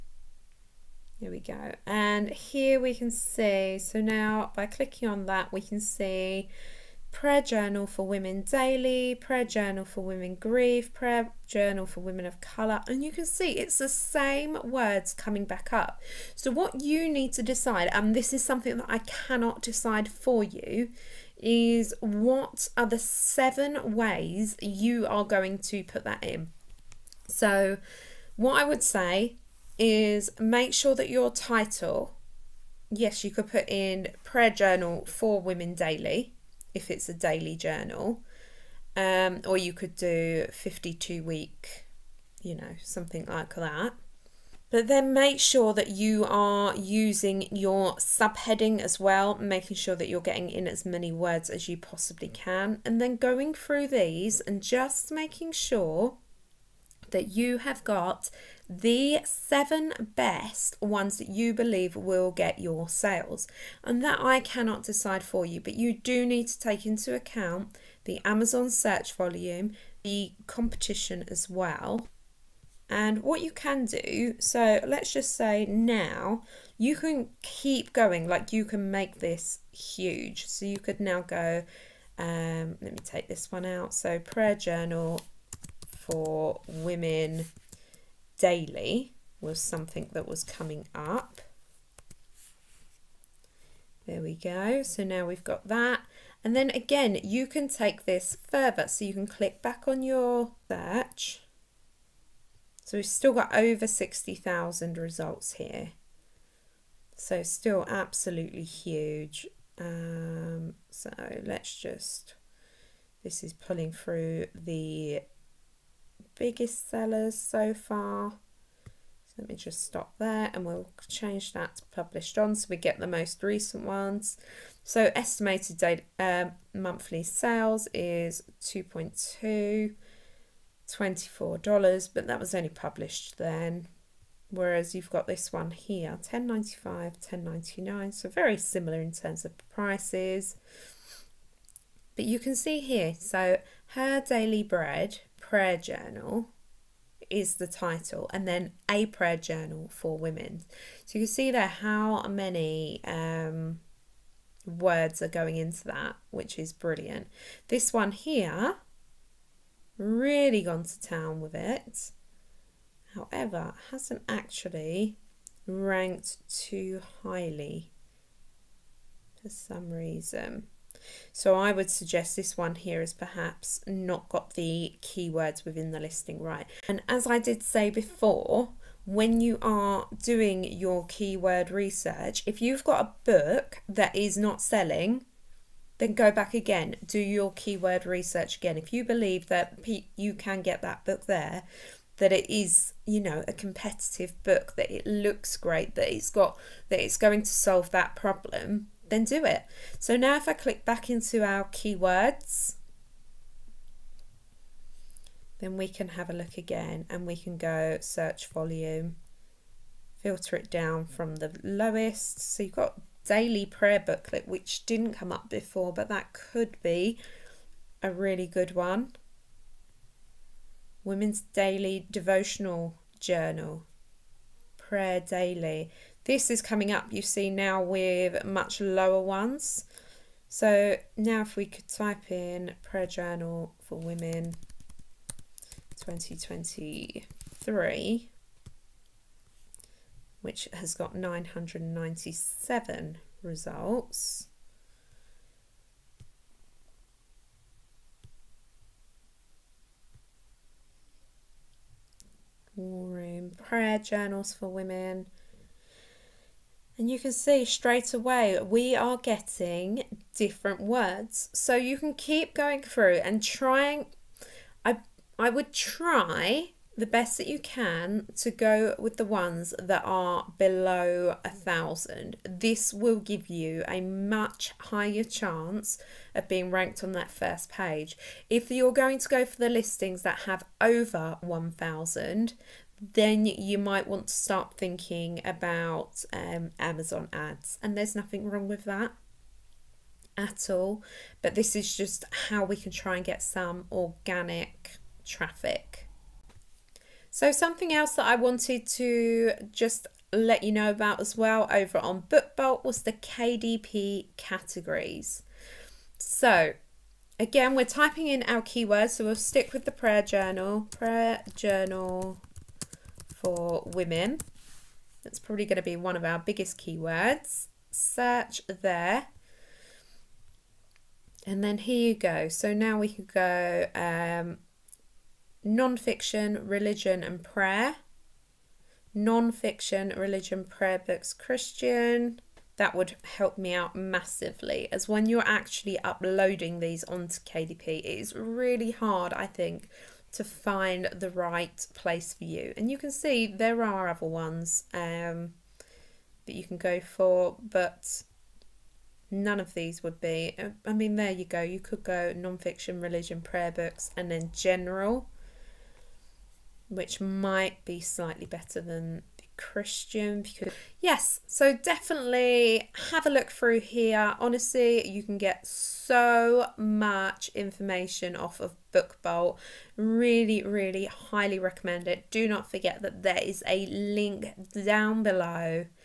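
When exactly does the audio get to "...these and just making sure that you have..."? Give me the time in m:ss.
0:53.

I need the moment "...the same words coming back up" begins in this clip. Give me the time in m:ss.
0:13.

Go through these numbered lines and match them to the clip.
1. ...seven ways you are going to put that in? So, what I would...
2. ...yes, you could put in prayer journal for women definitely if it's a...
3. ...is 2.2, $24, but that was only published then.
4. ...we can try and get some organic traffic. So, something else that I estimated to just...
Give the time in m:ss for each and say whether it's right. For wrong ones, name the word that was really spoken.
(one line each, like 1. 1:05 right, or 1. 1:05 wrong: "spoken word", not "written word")
1. 0:22 right
2. 0:32 wrong: "daily", not "definitely"
3. 2:07 right
4. 4:52 wrong: "wanted", not "estimated".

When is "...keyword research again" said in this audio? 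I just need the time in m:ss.
3:07.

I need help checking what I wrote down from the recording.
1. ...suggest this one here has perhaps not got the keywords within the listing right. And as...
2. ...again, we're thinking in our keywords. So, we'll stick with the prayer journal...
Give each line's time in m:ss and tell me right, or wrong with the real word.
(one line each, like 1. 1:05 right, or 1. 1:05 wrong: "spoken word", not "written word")
1. 2:51 right
2. 5:07 wrong: "typing", not "thinking".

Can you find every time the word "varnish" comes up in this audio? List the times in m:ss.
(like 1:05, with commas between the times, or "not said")
not said.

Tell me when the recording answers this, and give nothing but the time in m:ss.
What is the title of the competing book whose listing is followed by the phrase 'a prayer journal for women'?
2:23.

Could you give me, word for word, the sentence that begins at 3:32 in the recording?
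So you've got daily prayer booklet, which didn't come up before, but that could be a really good one.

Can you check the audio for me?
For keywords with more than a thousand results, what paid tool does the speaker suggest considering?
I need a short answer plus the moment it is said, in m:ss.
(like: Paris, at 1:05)
Amazon ads, at 4:46.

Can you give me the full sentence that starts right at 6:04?
Honestly, you can get so much information off of BookBolt.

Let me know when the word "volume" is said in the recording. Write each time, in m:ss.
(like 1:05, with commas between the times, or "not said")
1:09, 3:28.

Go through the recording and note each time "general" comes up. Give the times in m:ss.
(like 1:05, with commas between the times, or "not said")
5:54.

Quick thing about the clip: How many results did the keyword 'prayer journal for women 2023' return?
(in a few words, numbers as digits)
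997.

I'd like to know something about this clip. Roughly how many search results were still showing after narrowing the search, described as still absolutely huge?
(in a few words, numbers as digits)
over 60,000.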